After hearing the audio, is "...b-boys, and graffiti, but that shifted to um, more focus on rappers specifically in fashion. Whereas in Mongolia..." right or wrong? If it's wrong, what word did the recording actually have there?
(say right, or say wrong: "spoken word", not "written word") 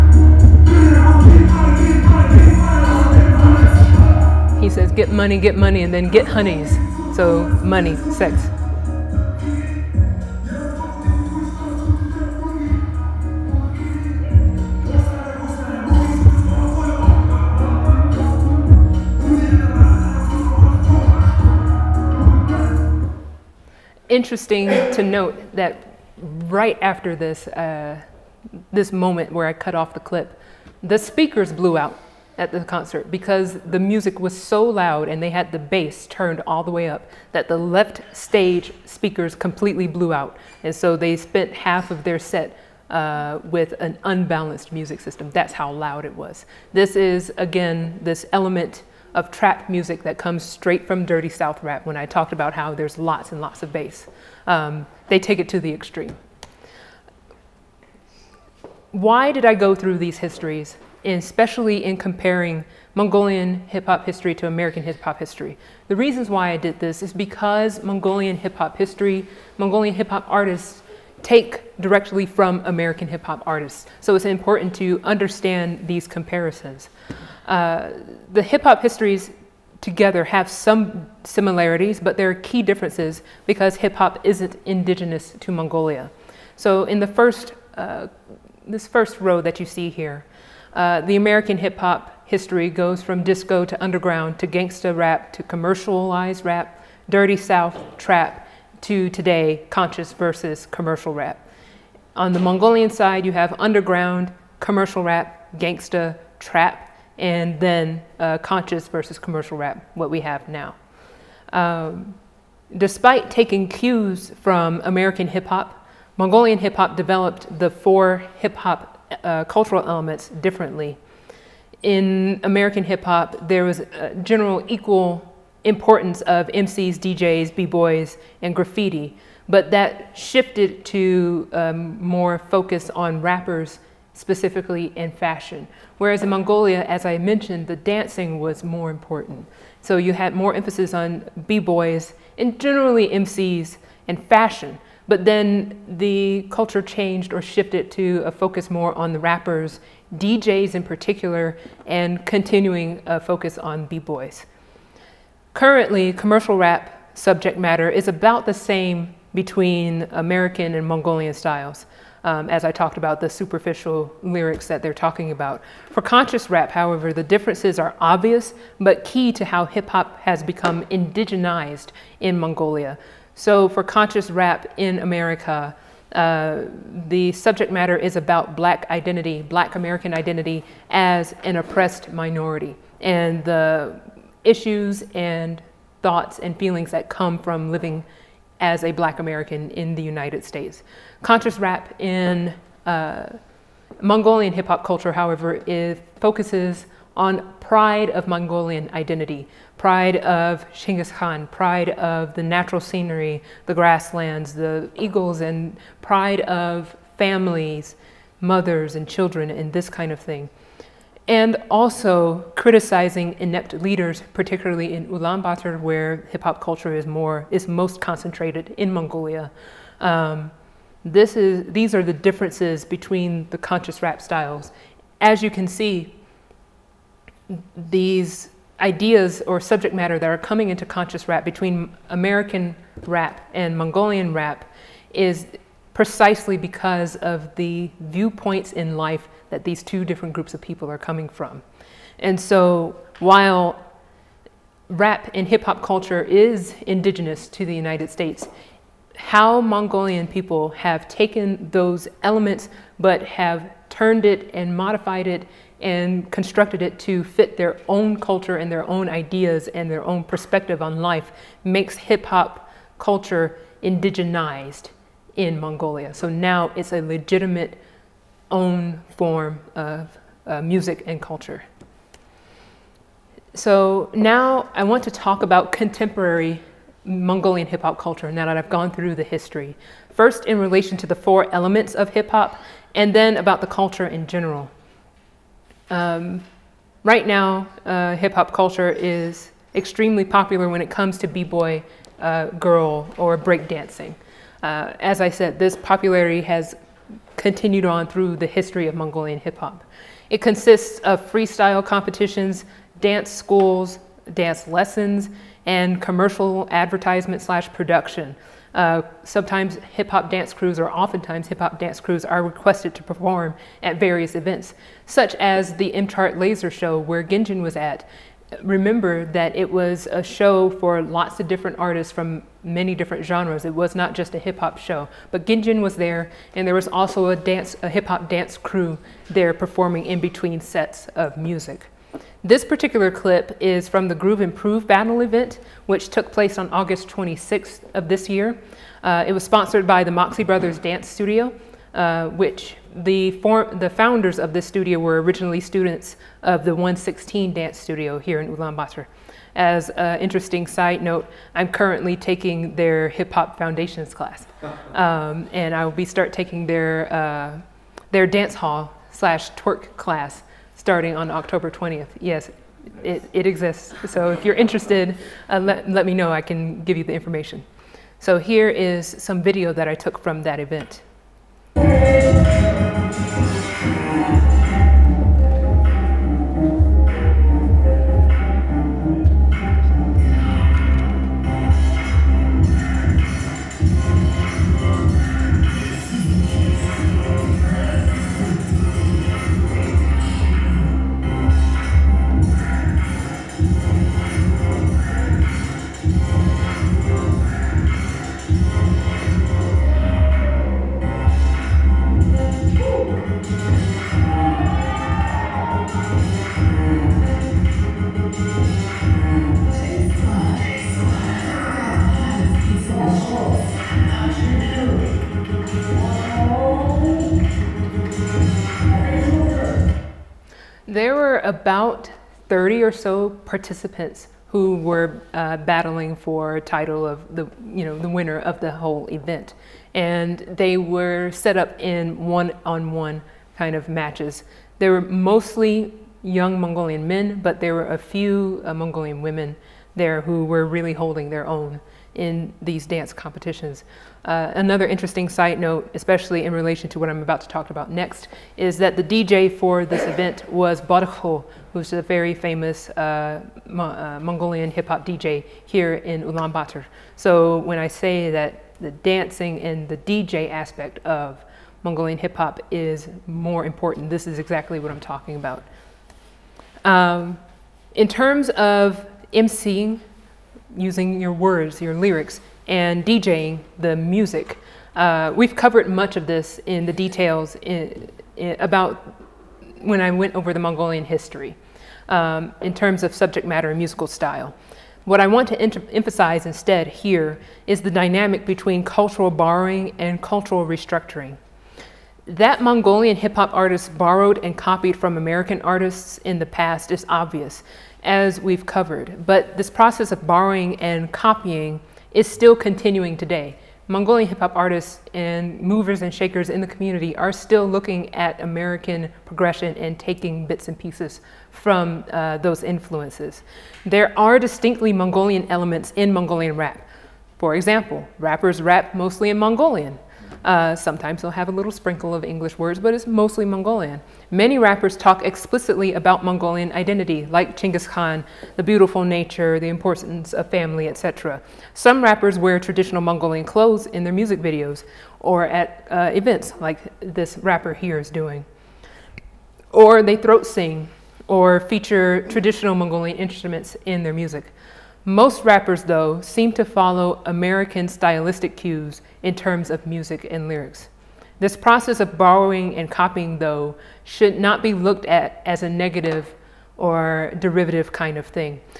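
right.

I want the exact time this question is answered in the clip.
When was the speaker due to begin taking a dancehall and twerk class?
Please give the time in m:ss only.
6:01.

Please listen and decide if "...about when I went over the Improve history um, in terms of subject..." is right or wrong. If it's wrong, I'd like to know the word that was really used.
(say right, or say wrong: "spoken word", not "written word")
wrong: "Mongolian", not "Improve".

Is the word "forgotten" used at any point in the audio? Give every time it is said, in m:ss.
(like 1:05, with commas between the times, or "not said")
not said.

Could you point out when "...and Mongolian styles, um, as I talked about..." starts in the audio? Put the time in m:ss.
2:40.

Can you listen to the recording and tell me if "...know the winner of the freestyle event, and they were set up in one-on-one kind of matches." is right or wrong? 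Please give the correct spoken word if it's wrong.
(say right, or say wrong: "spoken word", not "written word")
wrong: "whole", not "freestyle".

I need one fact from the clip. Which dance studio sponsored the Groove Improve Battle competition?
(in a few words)
Moxie Brothers Dance Studio.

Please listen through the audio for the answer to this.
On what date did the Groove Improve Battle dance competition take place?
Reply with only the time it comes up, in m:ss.
5:36.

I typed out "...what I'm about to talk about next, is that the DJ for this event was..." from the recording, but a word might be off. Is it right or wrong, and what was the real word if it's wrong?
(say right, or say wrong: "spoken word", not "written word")
right.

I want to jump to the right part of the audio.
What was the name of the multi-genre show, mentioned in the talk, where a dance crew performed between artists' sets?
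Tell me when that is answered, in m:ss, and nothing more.
5:15.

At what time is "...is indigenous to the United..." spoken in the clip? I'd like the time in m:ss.
4:06.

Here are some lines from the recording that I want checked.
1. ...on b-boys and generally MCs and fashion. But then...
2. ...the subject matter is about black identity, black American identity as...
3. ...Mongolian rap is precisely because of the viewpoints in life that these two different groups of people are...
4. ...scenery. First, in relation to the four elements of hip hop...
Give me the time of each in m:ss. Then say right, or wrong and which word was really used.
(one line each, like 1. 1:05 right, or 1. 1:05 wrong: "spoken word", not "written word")
1. 2:20 right
2. 2:57 right
3. 3:53 right
4. 4:39 wrong: "history", not "scenery".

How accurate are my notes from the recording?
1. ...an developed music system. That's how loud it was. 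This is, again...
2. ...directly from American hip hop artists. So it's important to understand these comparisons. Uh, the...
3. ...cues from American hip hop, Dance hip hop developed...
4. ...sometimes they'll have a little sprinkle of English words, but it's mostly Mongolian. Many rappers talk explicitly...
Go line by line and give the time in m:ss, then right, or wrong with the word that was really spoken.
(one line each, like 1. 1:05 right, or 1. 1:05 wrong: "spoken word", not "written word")
1. 0:43 wrong: "unbalanced", not "developed"
2. 1:11 right
3. 1:53 wrong: "Mongolian", not "Dance"
4. 8:40 right.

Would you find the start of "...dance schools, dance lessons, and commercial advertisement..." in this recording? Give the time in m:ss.
5:03.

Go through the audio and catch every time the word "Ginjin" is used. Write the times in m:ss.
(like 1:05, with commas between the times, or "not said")
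5:17, 5:25.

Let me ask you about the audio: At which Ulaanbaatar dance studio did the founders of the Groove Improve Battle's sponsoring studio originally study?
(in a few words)
116 dance studio.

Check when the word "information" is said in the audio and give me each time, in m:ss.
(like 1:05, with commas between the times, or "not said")
6:07.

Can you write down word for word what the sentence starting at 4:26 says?
So now it's a legitimate own form of uh, music and culture.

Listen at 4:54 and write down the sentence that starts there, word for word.
Uh, as I said, this popularity has continued on through the history of Mongolian hip hop.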